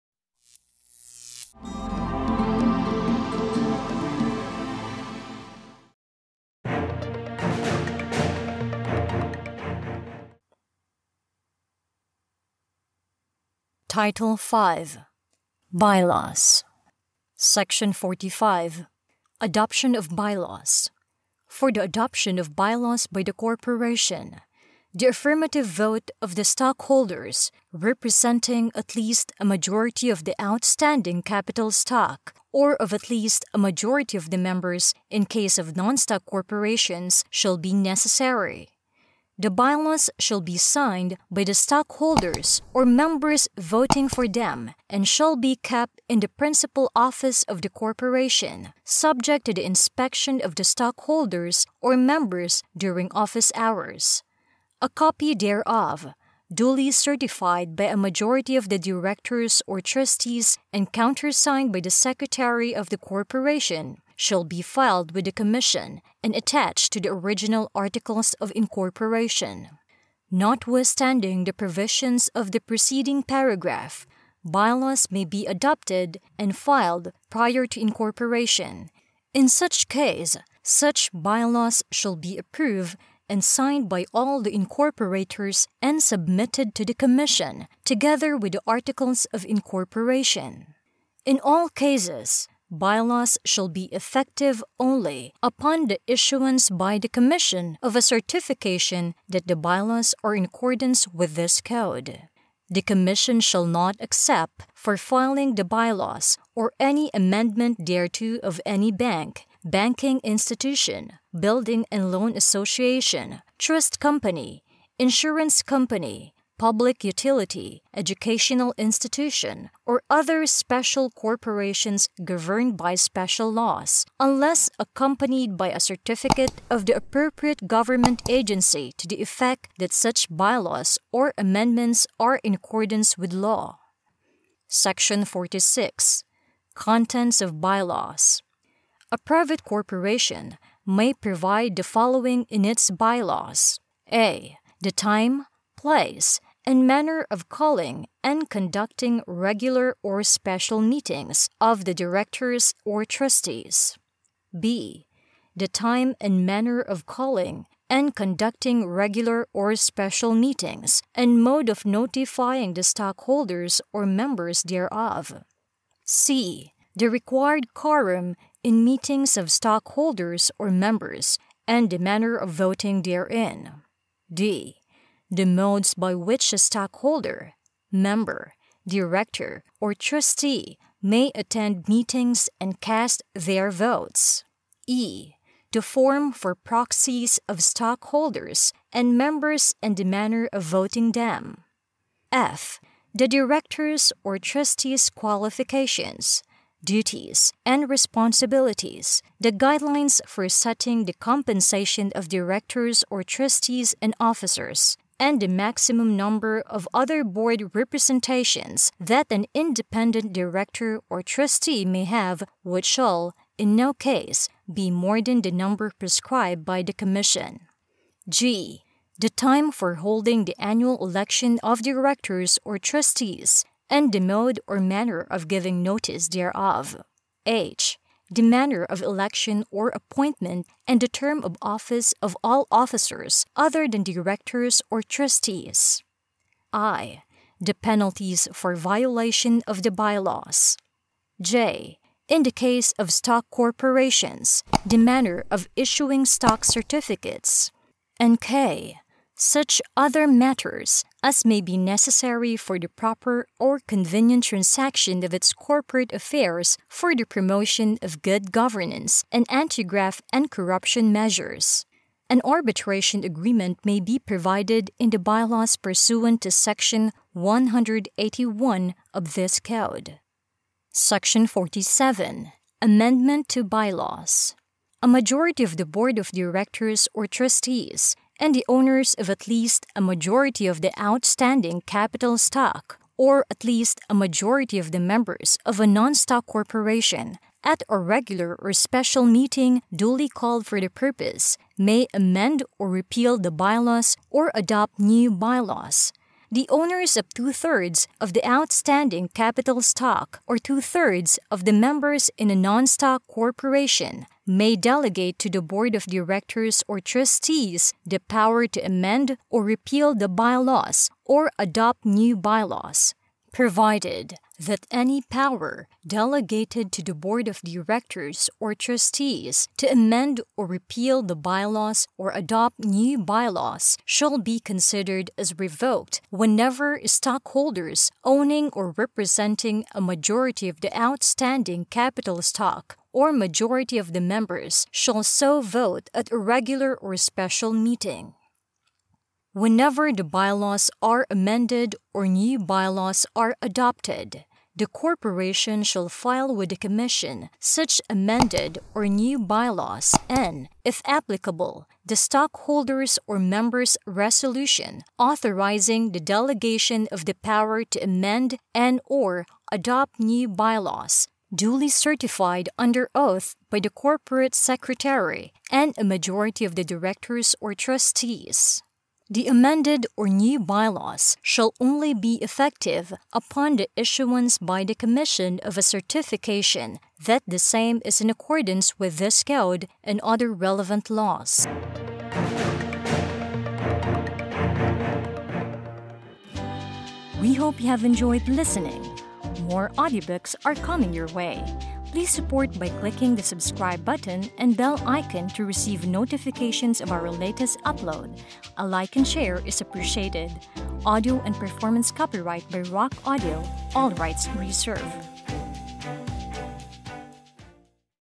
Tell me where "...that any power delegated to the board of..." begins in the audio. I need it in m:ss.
5:14.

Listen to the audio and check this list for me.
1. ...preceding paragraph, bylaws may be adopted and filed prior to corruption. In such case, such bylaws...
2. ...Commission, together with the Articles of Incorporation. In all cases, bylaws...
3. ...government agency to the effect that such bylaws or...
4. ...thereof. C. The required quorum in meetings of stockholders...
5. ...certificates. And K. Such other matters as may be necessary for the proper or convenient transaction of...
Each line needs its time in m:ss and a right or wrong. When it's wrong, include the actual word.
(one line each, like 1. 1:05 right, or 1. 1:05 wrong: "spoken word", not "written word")
1. 1:12 wrong: "incorporation", not "corruption"
2. 1:26 right
3. 2:07 right
4. 2:44 right
5. 4:06 right.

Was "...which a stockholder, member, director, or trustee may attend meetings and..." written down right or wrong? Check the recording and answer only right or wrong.
right.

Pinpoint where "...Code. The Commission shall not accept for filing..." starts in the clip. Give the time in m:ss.
1:41.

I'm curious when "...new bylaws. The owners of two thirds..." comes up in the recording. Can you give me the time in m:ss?
4:54.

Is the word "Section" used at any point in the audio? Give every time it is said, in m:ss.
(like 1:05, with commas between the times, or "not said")
0:17, 2:14, 4:26, 4:30.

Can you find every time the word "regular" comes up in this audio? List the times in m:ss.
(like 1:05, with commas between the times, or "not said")
2:29, 2:38, 4:47, 5:36.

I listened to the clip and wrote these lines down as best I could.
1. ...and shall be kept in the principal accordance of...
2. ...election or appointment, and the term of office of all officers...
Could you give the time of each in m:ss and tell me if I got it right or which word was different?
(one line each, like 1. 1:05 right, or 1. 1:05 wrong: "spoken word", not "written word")
1. 0:44 wrong: "office", not "accordance"
2. 3:49 right.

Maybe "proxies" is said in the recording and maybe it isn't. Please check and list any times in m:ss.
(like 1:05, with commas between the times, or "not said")
3:06.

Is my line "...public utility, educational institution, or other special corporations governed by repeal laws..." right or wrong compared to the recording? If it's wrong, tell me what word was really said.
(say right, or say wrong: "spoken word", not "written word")
wrong: "special", not "repeal".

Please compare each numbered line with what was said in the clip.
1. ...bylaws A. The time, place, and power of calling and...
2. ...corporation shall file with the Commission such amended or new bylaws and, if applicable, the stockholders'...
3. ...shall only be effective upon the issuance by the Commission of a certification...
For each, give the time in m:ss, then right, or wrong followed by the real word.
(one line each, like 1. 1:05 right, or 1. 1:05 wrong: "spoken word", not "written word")
1. 2:22 wrong: "manner", not "power"
2. 5:44 right
3. 6:11 right.